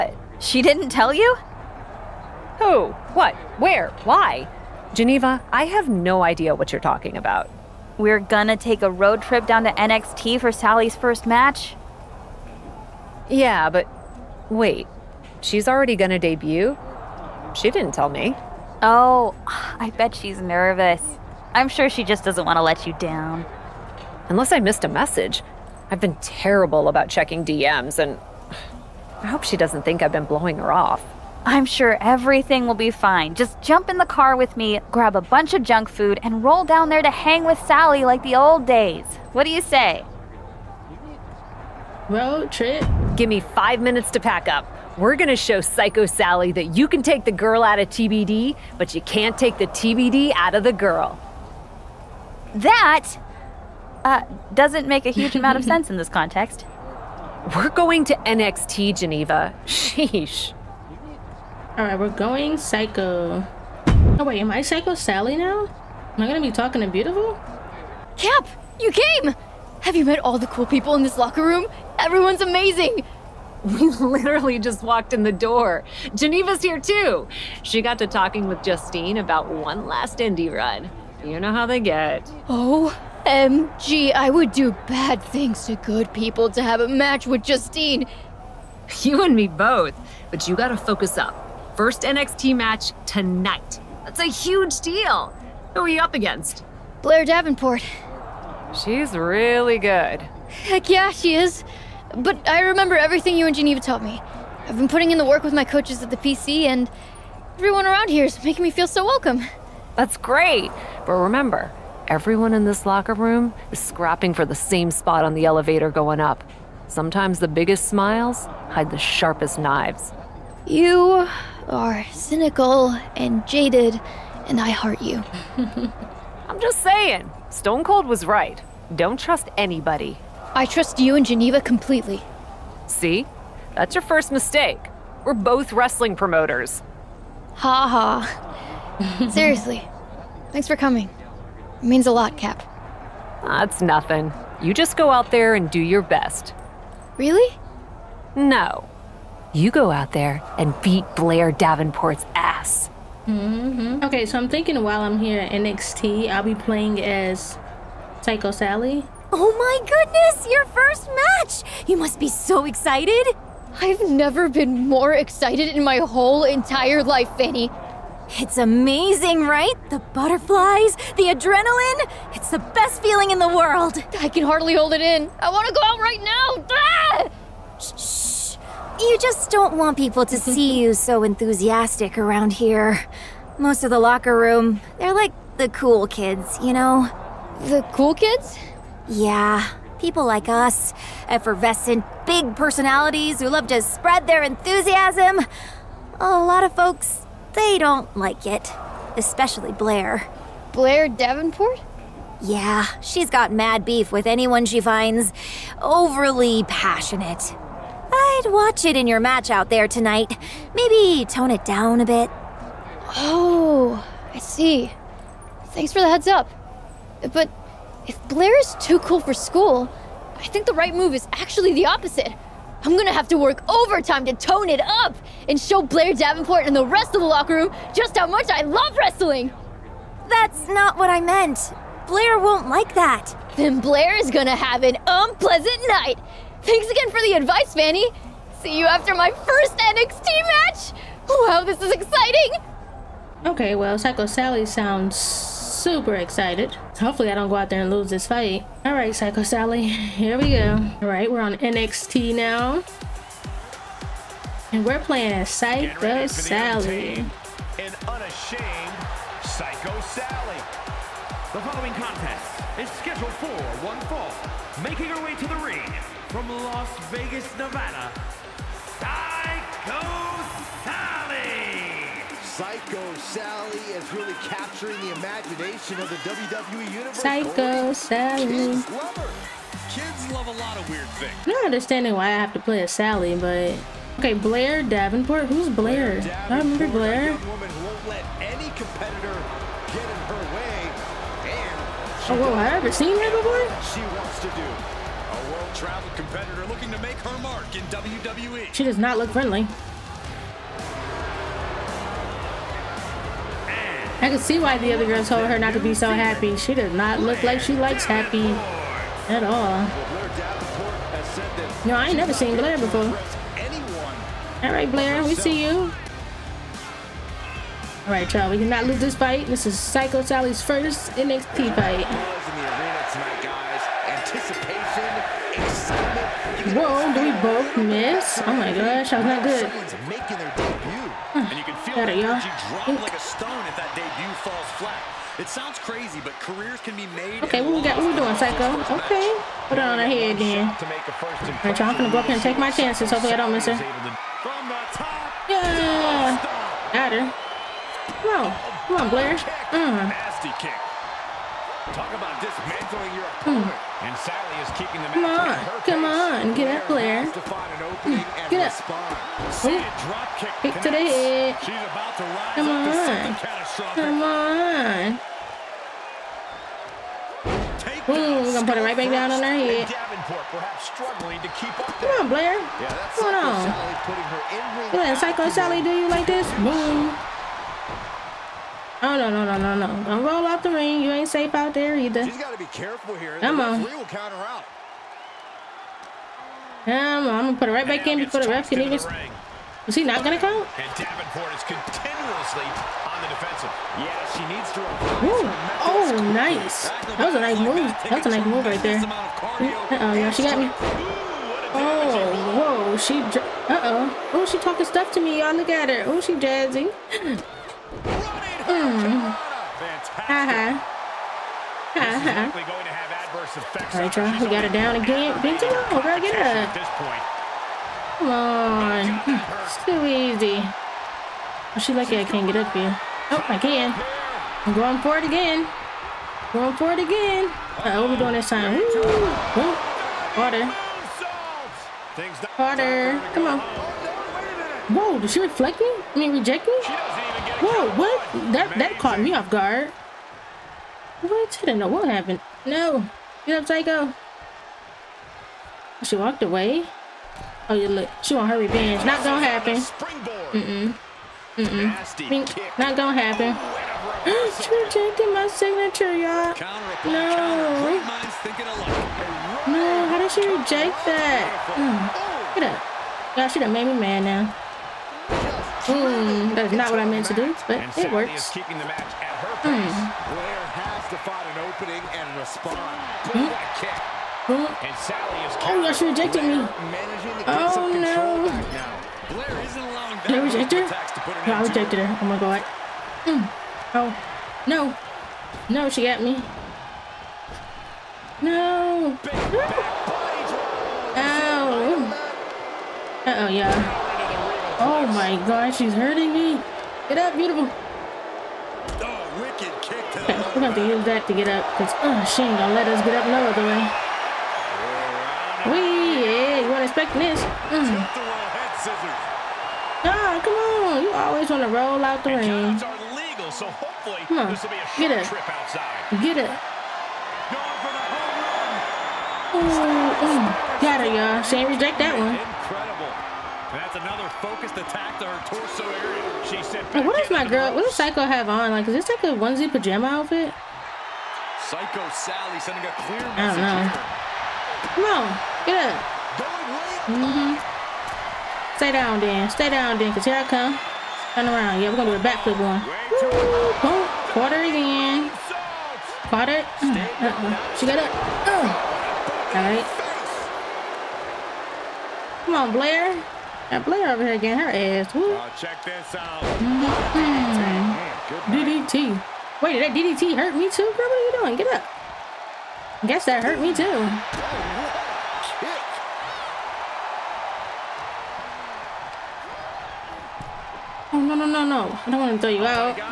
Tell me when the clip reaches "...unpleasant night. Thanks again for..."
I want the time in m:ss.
3:55.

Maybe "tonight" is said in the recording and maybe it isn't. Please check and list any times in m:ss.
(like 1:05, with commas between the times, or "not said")
1:33, 3:29.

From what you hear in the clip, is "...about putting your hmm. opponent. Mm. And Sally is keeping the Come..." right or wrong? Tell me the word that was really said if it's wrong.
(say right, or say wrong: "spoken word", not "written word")
wrong: "dismantling", not "putting".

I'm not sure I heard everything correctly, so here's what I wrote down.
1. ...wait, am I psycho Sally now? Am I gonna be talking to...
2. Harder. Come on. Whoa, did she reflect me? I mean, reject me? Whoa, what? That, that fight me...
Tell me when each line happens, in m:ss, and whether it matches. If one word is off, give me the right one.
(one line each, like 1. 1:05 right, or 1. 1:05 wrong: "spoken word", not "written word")
1. 1:04 right
2. 7:12 wrong: "caught", not "fight".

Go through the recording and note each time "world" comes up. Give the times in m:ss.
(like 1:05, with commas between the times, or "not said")
2:53, 4:55.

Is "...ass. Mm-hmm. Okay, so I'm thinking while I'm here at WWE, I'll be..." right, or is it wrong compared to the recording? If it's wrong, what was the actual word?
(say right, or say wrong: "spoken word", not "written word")
wrong: "NXT", not "WWE".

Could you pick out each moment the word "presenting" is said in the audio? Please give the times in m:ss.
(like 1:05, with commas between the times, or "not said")
not said.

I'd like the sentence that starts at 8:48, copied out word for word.
Like, is this like a onesie pajama outfit?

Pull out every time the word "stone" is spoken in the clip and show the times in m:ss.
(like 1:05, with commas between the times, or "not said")
2:07, 5:33.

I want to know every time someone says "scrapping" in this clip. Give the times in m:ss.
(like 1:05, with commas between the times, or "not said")
1:53.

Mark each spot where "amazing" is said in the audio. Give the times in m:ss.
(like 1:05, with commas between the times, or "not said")
1:12, 2:48.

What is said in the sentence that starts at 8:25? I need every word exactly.
We, yeah, you weren't expecting this.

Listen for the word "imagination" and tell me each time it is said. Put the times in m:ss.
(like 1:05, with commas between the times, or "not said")
4:35.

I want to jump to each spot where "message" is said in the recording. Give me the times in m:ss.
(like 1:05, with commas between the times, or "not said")
0:24, 8:53.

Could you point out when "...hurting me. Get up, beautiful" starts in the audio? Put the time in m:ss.
8:15.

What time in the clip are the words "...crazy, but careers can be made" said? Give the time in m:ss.
5:35.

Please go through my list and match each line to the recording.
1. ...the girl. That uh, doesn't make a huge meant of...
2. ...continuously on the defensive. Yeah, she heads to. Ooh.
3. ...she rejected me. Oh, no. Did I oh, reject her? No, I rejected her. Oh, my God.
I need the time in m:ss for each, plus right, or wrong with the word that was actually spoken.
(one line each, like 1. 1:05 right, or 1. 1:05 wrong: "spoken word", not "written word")
1. 0:50 wrong: "amount", not "meant"
2. 6:31 wrong: "needs", not "heads"
3. 7:55 right.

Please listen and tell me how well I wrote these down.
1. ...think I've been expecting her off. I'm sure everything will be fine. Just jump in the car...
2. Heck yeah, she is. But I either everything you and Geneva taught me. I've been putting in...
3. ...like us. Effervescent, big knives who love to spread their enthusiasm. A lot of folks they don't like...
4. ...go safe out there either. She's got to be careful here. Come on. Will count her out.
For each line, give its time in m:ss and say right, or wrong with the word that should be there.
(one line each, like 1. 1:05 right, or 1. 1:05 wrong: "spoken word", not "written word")
1. 0:29 wrong: "blowing", not "expecting"
2. 1:40 wrong: "remember", not "either"
3. 3:10 wrong: "personalities", not "knives"
4. 6:20 right.